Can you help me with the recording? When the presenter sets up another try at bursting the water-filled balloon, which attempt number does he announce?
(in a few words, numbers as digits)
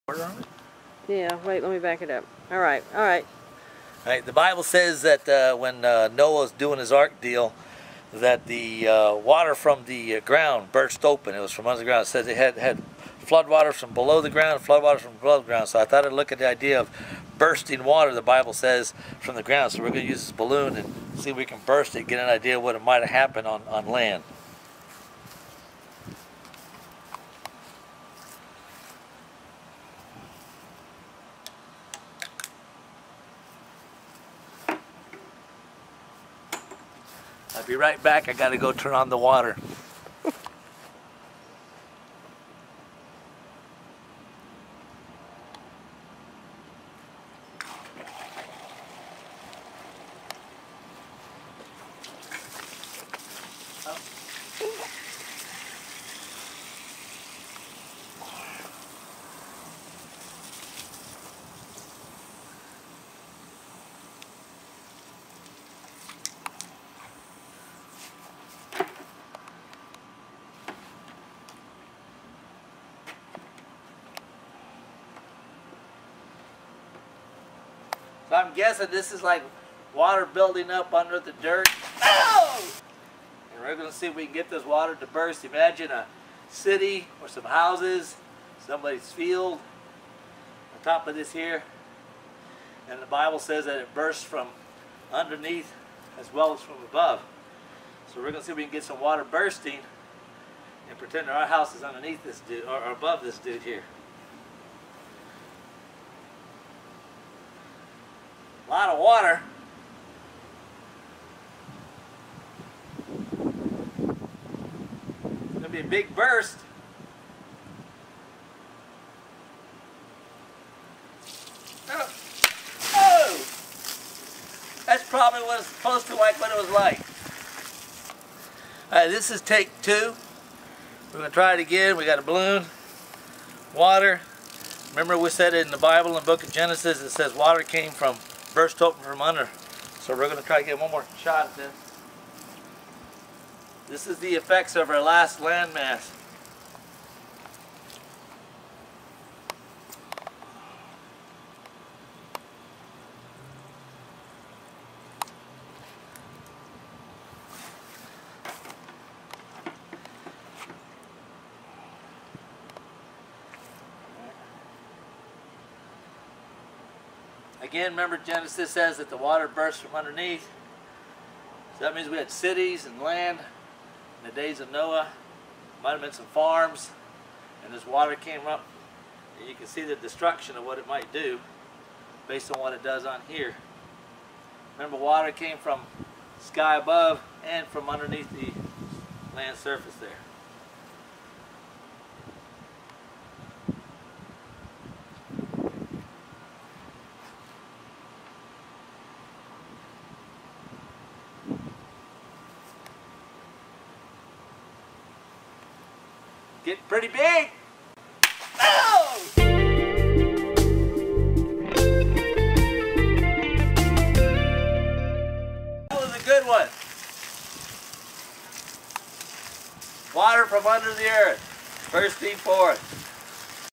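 2.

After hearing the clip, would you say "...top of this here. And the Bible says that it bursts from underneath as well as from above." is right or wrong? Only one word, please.
right.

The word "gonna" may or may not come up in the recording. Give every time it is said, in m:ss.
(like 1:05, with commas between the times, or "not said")
1:23, 1:38, 1:55, 2:11.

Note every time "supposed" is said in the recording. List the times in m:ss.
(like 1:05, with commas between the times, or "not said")
2:05.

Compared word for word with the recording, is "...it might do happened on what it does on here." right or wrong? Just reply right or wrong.
wrong.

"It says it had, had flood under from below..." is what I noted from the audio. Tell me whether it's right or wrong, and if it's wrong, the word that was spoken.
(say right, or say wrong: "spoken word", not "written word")
wrong: "water", not "under".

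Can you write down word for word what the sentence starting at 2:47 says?
Again, remember Genesis says that the water burst from underneath.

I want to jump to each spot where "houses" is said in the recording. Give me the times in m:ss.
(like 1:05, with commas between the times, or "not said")
1:27, 1:41.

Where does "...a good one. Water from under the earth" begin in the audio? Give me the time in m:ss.
3:36.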